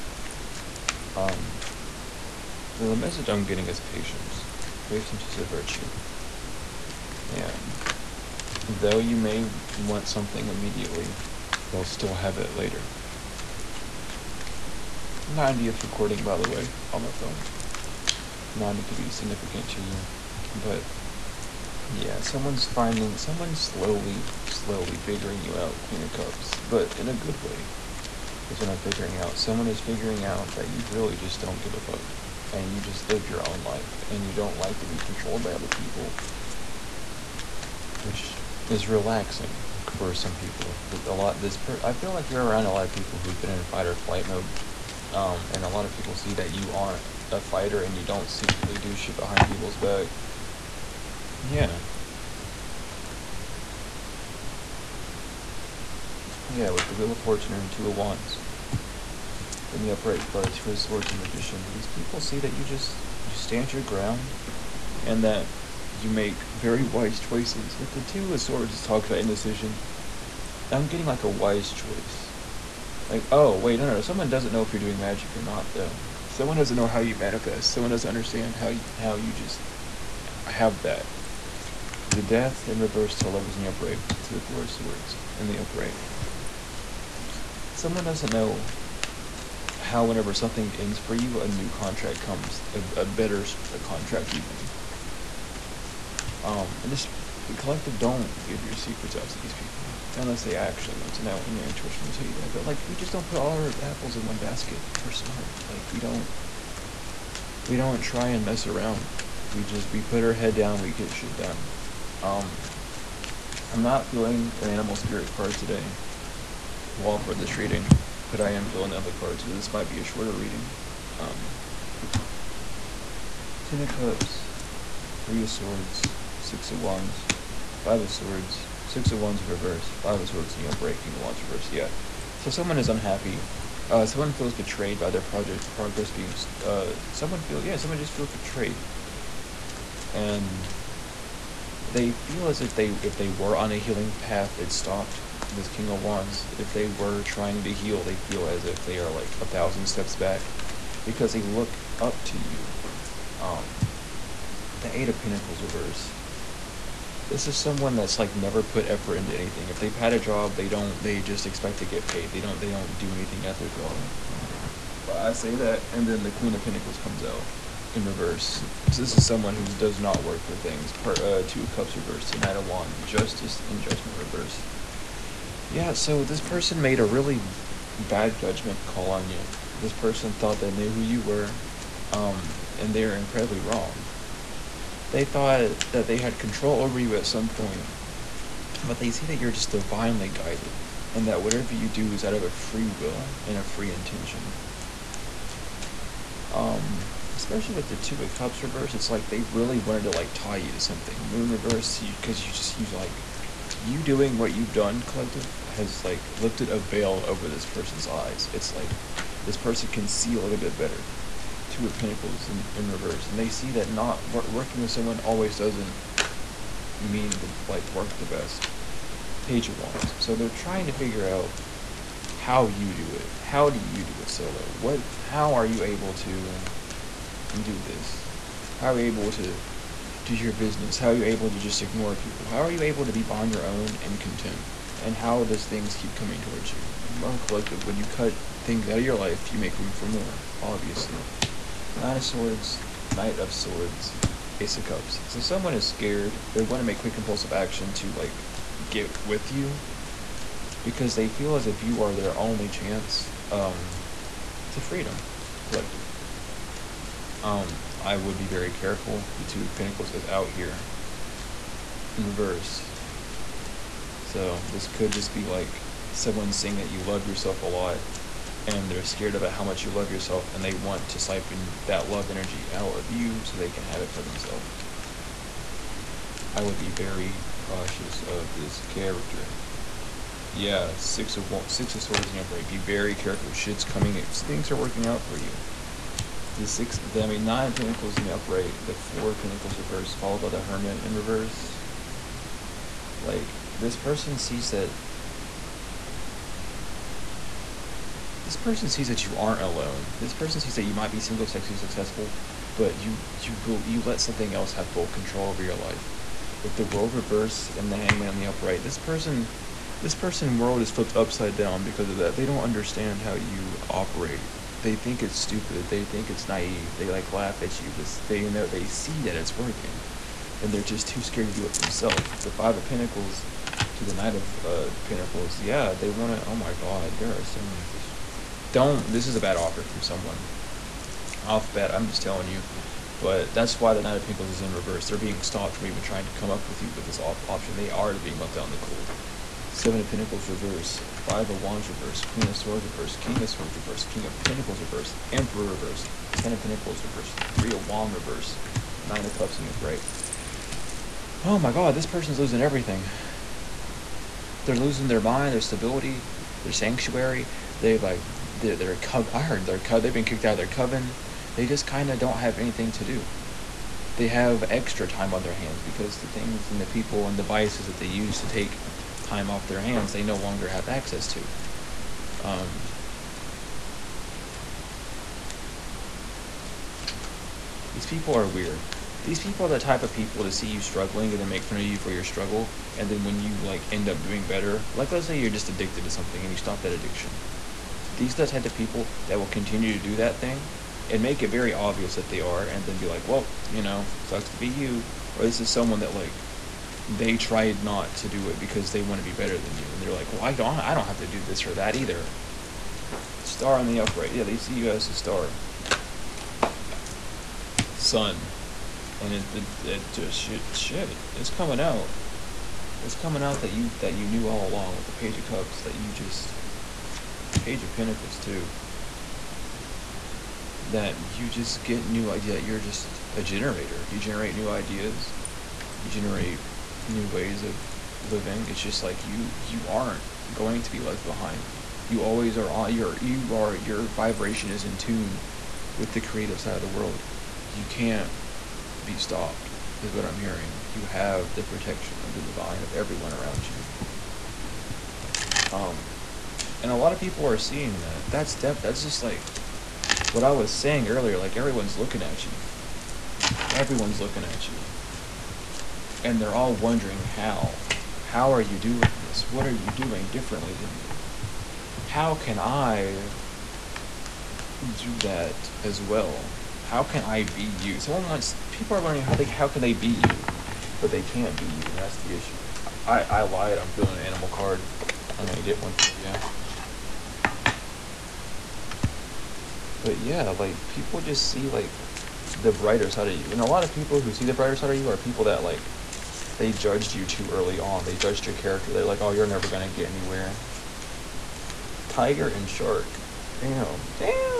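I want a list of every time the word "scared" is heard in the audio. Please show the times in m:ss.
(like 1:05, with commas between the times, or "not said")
4:05, 4:29, 5:21.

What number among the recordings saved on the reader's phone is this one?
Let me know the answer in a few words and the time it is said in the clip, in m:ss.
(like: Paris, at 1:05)
90, at 0:15.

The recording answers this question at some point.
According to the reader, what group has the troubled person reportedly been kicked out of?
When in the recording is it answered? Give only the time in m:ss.
6:00.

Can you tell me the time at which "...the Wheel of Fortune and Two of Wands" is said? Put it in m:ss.
0:56.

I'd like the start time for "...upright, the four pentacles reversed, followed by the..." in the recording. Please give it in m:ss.
4:48.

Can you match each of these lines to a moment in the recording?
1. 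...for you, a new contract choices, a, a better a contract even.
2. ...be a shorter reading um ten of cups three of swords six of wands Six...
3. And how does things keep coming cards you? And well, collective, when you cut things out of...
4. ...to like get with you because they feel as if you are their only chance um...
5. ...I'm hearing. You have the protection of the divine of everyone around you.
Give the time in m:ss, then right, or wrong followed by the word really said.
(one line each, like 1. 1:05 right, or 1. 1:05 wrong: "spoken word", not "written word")
1. 1:30 wrong: "comes", not "choices"
2. 1:59 wrong: "Five", not "Six"
3. 3:55 wrong: "towards", not "cards"
4. 4:07 right
5. 7:20 right.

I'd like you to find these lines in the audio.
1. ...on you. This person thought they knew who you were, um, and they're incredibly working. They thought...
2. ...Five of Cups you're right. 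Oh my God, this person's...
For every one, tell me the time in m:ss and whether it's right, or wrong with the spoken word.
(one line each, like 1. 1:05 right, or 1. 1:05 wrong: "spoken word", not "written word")
1. 2:59 wrong: "wrong", not "working"
2. 5:49 wrong: "Nine", not "Five".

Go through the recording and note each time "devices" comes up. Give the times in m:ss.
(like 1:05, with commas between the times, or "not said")
6:07.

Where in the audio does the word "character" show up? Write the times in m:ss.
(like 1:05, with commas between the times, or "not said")
4:38, 8:08.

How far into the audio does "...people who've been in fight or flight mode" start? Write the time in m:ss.
0:42.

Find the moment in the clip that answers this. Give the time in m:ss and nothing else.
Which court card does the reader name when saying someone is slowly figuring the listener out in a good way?
0:25.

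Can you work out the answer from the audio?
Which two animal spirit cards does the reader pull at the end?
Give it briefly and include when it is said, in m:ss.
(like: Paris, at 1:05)
Tiger and shark, at 8:12.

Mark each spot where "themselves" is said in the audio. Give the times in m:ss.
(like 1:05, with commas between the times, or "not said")
4:34, 5:21.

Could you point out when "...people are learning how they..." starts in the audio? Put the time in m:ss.
7:48.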